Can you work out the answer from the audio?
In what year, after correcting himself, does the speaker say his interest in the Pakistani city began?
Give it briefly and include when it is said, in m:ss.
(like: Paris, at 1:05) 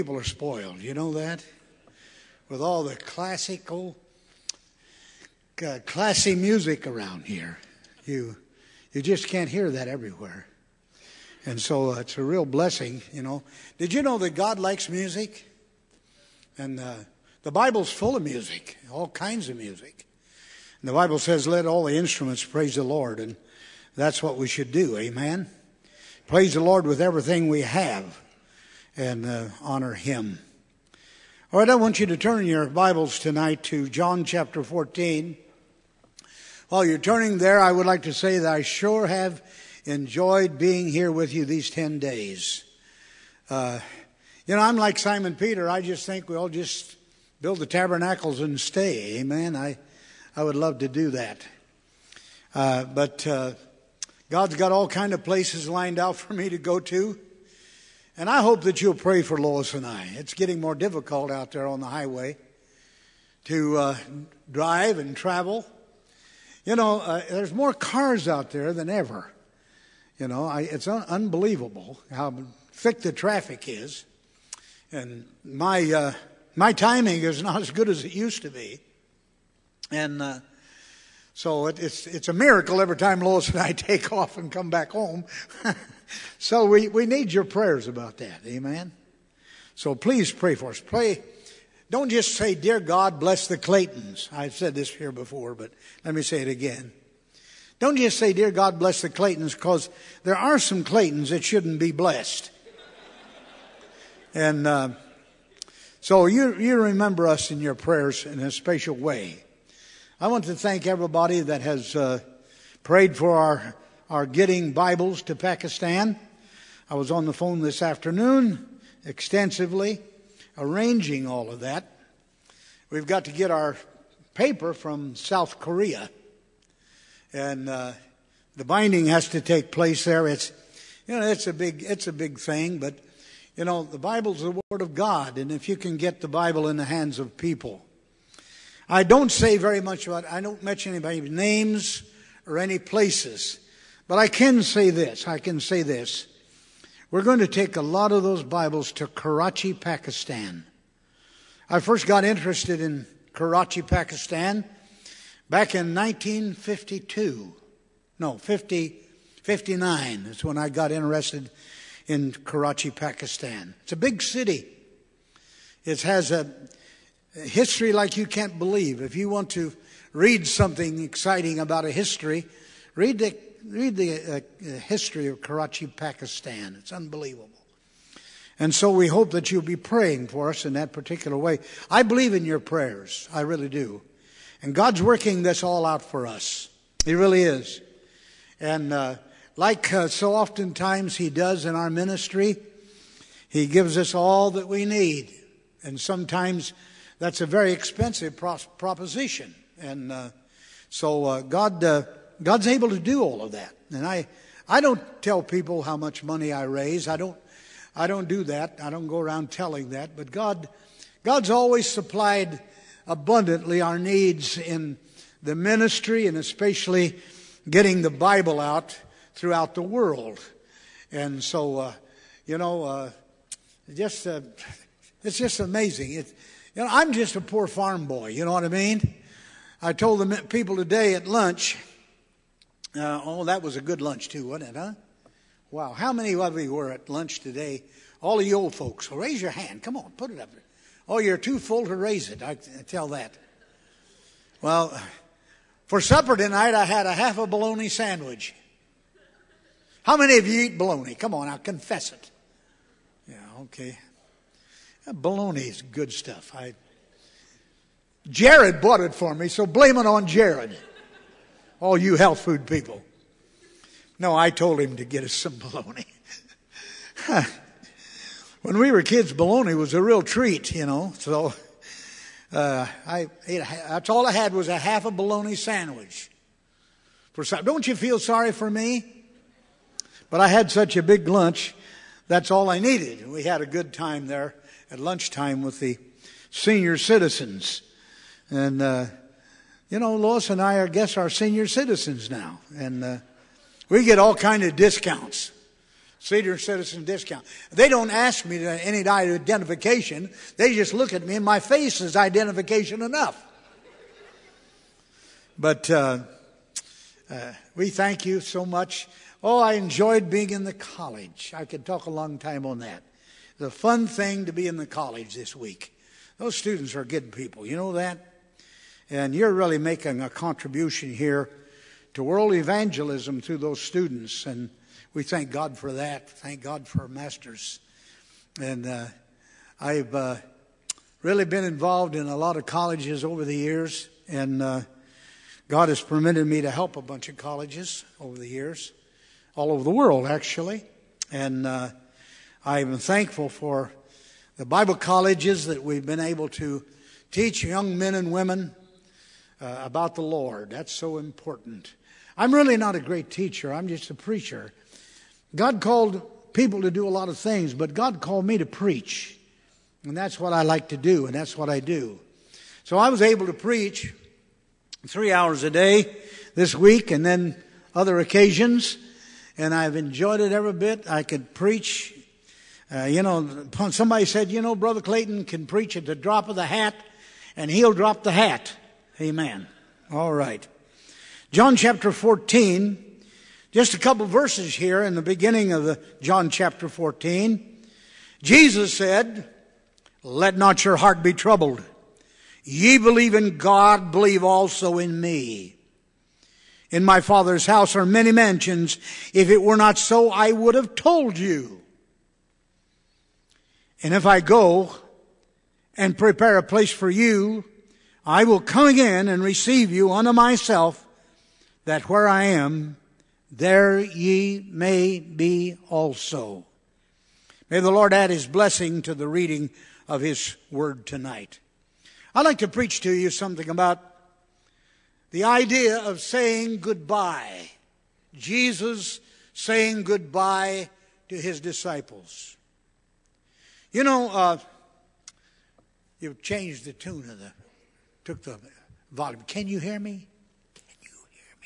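1959, at 2:39.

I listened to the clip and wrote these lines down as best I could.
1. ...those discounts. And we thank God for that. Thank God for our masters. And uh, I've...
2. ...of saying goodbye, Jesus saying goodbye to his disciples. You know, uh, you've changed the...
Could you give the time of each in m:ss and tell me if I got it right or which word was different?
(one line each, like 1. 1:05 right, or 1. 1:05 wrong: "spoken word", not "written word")
1. 5:23 wrong: "students", not "discounts"
2. 7:05 right.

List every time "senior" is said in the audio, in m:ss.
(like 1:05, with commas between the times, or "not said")
4:46, 4:51, 4:56.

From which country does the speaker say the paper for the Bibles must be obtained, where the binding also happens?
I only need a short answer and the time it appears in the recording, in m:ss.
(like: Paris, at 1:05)
South Korea, at 2:05.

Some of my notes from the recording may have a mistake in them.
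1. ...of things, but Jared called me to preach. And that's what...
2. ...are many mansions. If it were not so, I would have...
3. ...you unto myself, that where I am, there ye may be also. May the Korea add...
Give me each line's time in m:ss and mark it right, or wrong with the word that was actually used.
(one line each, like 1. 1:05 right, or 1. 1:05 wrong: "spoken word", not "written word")
1. 5:57 wrong: "God", not "Jared"
2. 6:37 right
3. 6:49 wrong: "Lord", not "Korea".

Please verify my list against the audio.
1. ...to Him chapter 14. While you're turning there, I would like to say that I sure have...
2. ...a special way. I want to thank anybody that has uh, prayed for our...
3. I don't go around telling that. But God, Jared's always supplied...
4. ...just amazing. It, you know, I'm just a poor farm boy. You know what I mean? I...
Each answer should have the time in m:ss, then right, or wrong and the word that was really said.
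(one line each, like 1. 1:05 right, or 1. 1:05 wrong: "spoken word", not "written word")
1. 0:33 wrong: "John", not "Him"
2. 1:48 wrong: "everybody", not "anybody"
3. 3:28 wrong: "God", not "Jared"
4. 3:45 right.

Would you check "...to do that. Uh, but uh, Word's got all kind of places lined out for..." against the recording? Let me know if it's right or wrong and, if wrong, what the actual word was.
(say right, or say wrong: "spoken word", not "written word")
wrong: "God", not "Word".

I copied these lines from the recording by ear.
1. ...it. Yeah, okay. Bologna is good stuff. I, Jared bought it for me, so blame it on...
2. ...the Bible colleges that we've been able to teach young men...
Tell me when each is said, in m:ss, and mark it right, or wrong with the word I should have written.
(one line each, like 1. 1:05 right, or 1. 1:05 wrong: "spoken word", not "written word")
1. 4:12 right
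2. 5:44 right.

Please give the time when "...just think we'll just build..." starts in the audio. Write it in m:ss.
0:45.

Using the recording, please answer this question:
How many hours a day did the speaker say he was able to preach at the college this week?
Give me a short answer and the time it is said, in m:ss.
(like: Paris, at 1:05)
3, at 6:05.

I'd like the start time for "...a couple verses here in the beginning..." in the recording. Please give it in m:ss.
6:23.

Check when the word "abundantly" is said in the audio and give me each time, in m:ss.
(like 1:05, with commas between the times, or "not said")
3:33.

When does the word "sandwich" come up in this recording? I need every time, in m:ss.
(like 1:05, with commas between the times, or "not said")
4:07, 4:35.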